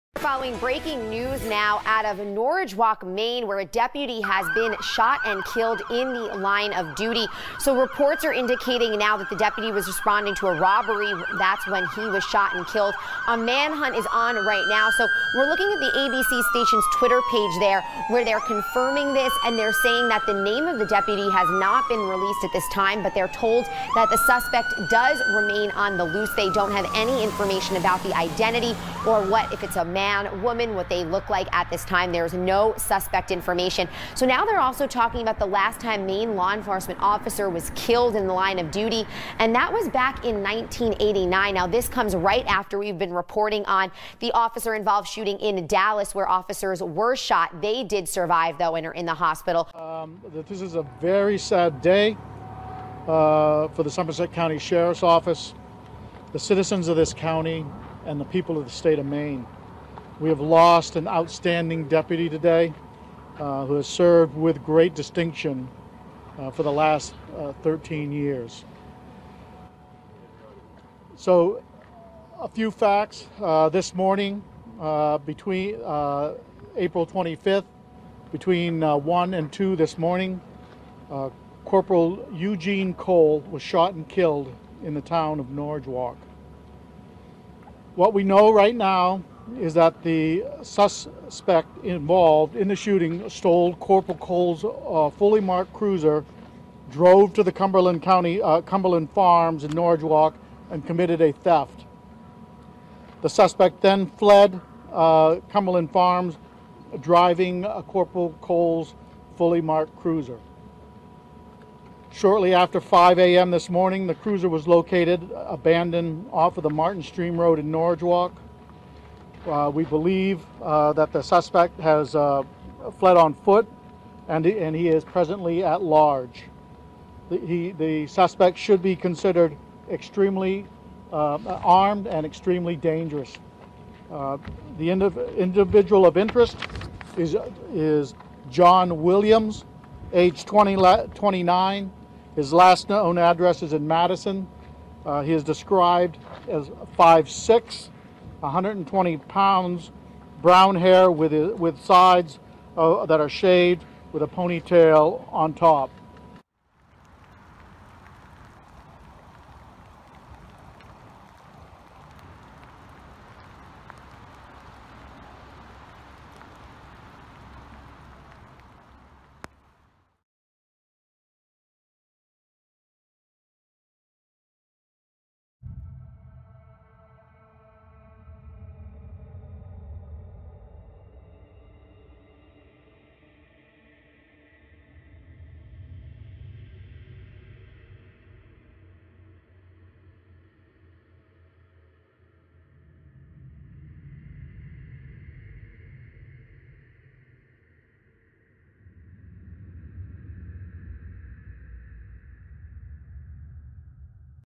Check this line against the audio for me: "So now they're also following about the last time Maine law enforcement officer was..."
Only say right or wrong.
wrong.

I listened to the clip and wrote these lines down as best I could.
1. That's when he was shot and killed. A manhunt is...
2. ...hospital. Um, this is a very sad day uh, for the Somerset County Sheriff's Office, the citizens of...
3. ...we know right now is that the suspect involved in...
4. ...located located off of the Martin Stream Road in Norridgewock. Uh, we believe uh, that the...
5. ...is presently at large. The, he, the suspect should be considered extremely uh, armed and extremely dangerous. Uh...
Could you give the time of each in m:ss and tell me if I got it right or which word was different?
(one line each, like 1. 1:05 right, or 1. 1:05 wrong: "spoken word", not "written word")
1. 0:11 right
2. 0:49 right
3. 1:28 right
4. 1:54 wrong: "abandoned", not "located"
5. 2:04 right.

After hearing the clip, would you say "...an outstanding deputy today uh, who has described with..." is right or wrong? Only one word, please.
wrong.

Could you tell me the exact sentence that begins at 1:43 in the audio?
The suspect then fled uh, Cumberland Farms, driving uh, Corporal Cole's fully marked cruiser.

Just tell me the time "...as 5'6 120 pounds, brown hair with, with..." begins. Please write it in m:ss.
2:26.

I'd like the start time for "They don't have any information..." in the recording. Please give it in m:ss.
0:26.